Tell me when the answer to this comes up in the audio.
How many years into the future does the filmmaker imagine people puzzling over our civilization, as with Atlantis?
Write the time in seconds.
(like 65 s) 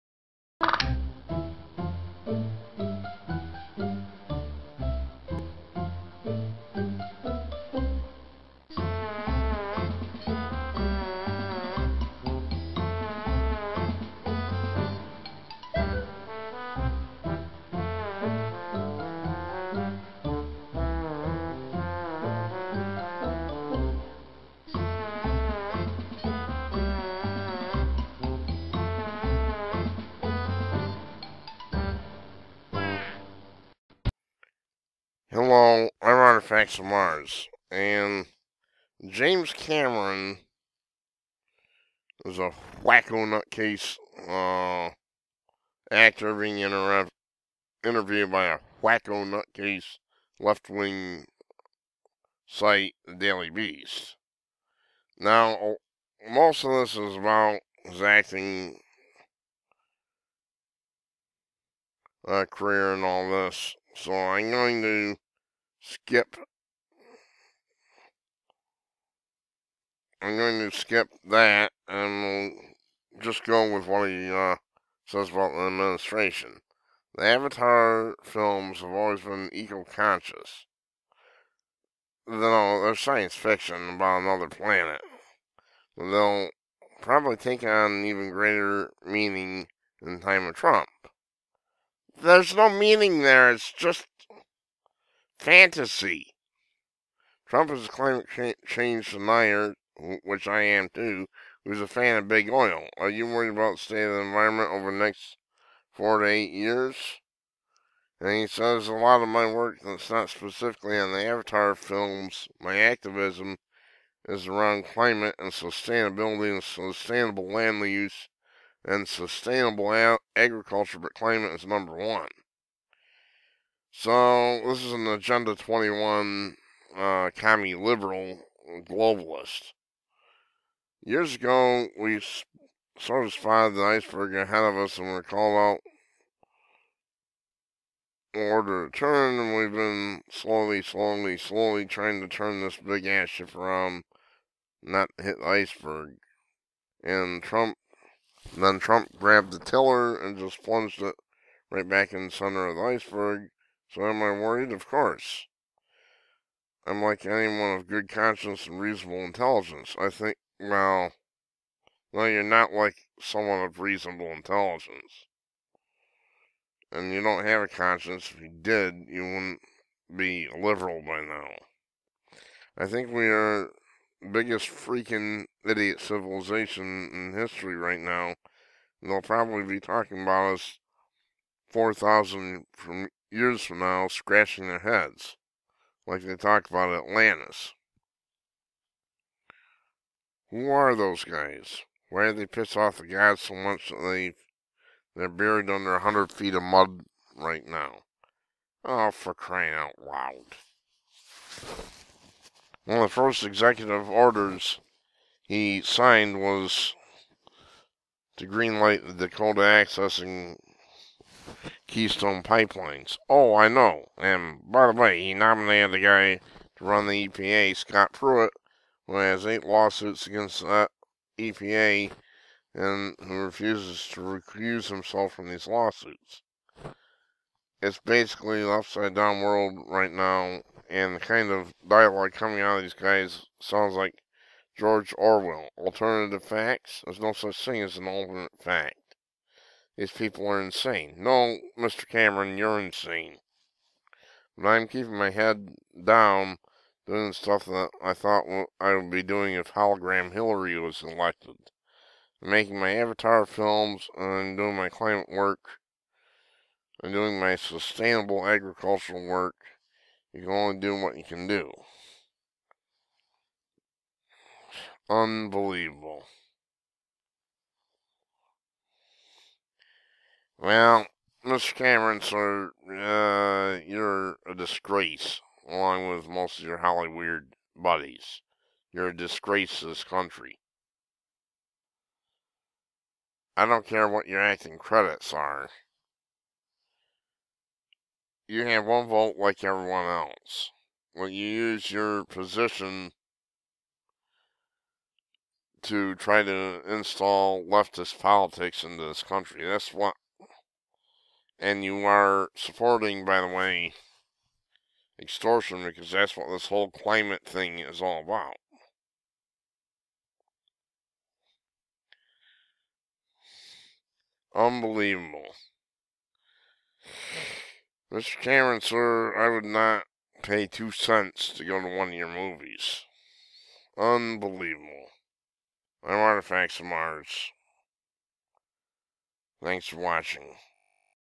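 181 s.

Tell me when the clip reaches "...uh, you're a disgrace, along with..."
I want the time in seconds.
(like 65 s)
272 s.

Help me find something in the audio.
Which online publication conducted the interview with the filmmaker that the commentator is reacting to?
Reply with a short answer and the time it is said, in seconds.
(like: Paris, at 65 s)
Daily Beast, at 53 s.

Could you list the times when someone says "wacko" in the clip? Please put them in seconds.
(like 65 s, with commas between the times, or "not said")
42 s, 48 s.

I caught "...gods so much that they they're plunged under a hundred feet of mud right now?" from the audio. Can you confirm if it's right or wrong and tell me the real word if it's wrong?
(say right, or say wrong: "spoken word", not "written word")
wrong: "buried", not "plunged".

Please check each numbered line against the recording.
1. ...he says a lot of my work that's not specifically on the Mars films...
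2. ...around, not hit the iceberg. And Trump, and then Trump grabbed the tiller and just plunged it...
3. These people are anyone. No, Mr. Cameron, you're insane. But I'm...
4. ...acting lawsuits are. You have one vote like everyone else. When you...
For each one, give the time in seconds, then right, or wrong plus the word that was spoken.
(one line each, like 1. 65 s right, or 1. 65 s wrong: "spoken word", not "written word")
1. 108 s wrong: "Avatar", not "Mars"
2. 143 s right
3. 239 s wrong: "insane", not "anyone"
4. 284 s wrong: "credits", not "lawsuits".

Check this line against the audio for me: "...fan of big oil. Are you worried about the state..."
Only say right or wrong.
right.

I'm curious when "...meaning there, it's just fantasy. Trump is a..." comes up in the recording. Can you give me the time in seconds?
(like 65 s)
92 s.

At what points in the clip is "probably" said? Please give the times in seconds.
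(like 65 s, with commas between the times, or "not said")
87 s, 179 s.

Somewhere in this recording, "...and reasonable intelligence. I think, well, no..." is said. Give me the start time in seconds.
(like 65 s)
158 s.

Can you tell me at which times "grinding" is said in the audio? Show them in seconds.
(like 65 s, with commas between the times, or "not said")
not said.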